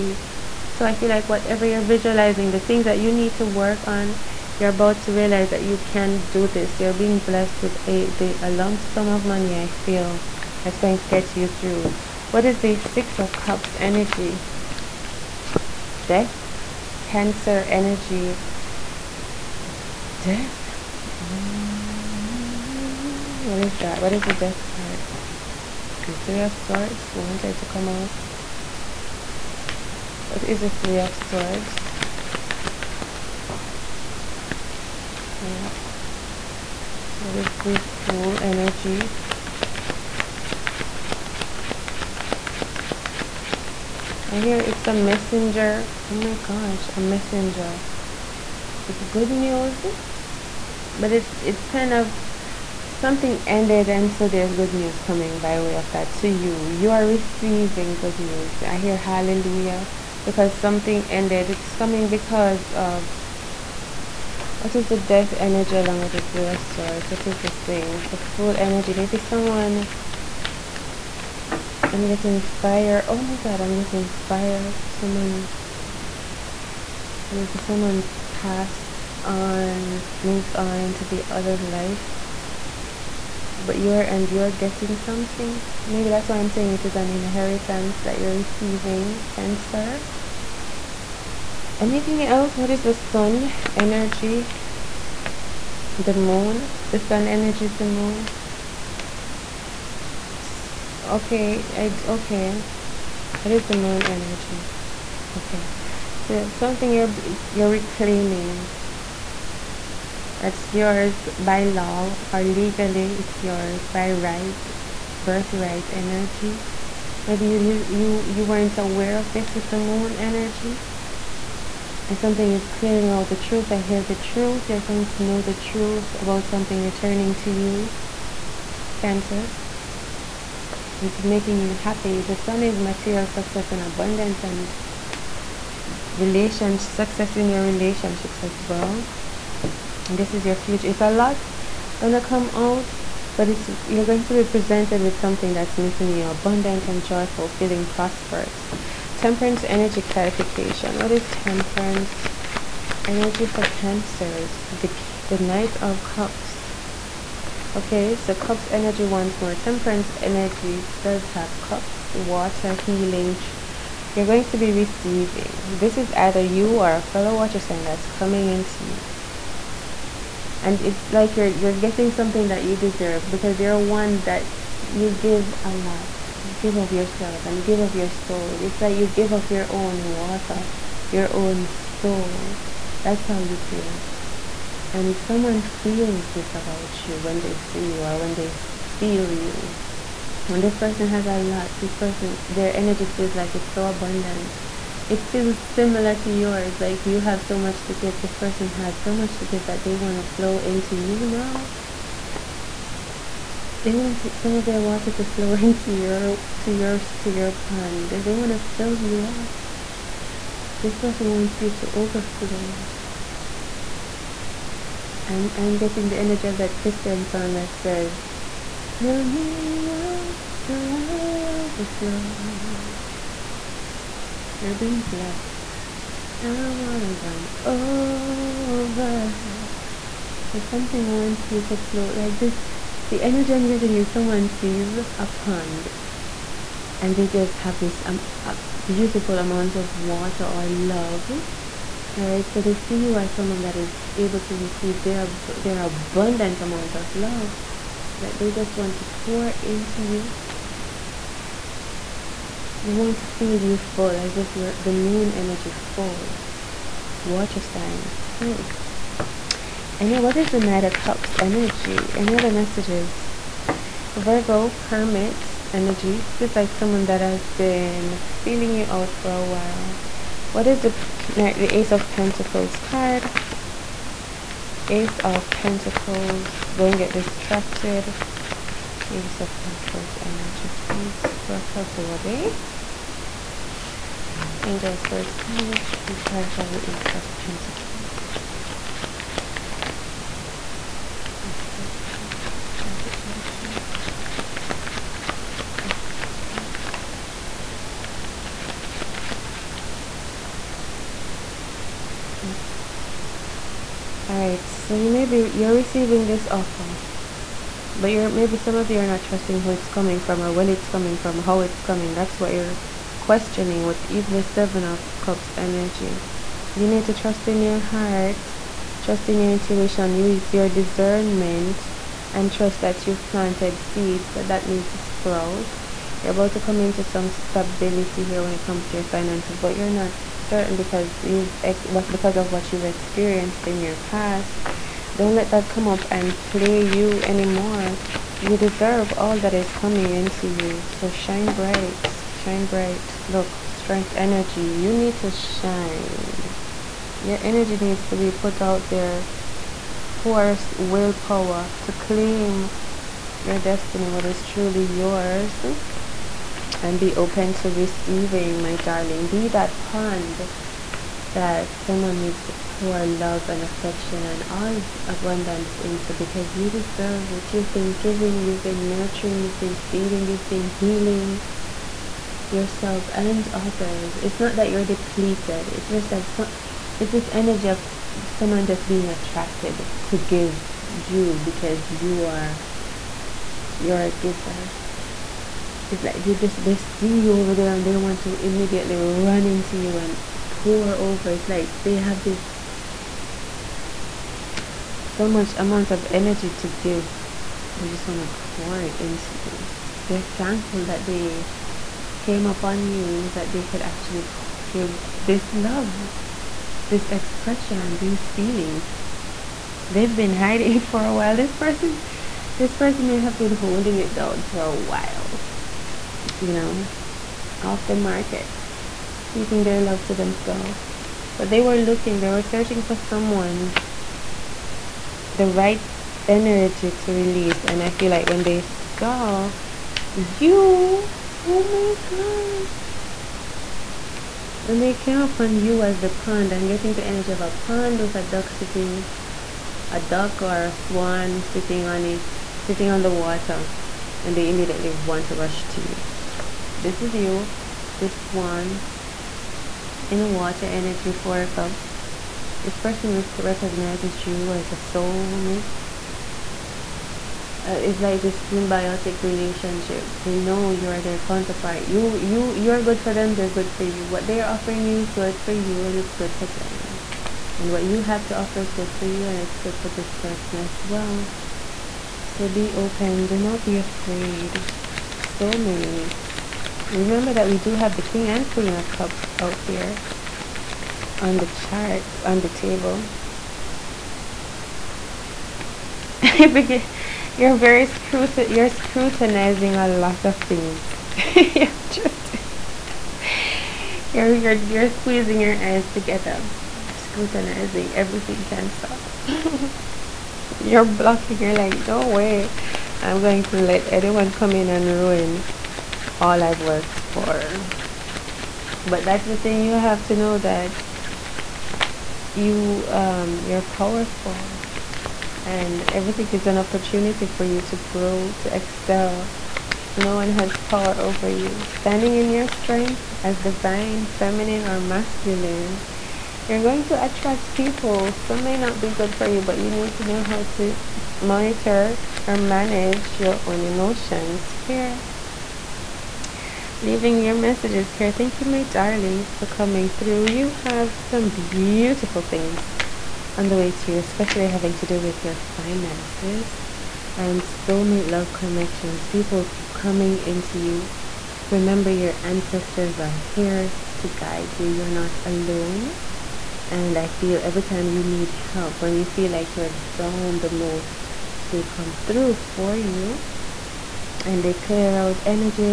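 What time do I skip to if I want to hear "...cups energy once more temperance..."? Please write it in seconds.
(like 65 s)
158 s.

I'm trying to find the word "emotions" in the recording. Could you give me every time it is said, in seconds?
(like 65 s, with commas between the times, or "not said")
533 s.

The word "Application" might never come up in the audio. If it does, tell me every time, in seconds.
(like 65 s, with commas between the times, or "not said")
292 s.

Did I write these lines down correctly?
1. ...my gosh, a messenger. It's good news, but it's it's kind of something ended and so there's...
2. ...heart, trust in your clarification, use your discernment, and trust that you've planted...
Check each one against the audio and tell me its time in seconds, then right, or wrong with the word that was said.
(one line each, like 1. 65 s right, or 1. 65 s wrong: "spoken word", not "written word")
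1. 46 s right
2. 317 s wrong: "intuition", not "clarification".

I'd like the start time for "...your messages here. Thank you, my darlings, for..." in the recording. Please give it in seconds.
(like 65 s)
537 s.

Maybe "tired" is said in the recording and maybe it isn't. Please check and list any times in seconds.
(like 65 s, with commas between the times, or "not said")
not said.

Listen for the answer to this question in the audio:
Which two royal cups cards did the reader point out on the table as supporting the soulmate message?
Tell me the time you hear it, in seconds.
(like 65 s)
478 s.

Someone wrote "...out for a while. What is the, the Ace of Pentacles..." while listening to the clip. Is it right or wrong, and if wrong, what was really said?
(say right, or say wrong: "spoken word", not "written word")
right.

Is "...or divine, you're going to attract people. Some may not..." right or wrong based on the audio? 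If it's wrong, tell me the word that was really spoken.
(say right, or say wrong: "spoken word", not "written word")
wrong: "masculine", not "divine".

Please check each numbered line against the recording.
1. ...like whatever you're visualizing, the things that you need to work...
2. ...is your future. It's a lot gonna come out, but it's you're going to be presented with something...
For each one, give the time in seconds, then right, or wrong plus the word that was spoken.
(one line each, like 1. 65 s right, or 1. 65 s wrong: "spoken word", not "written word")
1. 1 s right
2. 140 s right.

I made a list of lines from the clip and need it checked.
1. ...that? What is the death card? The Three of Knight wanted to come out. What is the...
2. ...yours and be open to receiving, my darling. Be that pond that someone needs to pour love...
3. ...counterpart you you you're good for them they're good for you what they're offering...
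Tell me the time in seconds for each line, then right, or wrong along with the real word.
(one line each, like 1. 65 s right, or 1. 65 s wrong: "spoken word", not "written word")
1. 23 s wrong: "Swords", not "Knight"
2. 354 s right
3. 461 s right.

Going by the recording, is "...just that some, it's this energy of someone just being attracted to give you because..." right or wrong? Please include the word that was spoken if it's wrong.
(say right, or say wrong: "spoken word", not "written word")
right.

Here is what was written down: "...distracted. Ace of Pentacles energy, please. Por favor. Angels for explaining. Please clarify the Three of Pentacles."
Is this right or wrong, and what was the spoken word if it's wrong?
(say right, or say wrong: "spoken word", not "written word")
wrong: "Ace", not "Three".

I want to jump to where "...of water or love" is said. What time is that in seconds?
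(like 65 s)
239 s.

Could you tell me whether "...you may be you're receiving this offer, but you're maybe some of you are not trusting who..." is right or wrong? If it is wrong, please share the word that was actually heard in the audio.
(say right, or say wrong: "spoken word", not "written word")
right.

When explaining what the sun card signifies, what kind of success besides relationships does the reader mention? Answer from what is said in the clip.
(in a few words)
Material success.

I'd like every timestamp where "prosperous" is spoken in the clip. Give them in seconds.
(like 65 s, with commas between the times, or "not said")
147 s.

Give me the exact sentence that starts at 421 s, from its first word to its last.
But they were looking, they were searching for someone, the right energy to release.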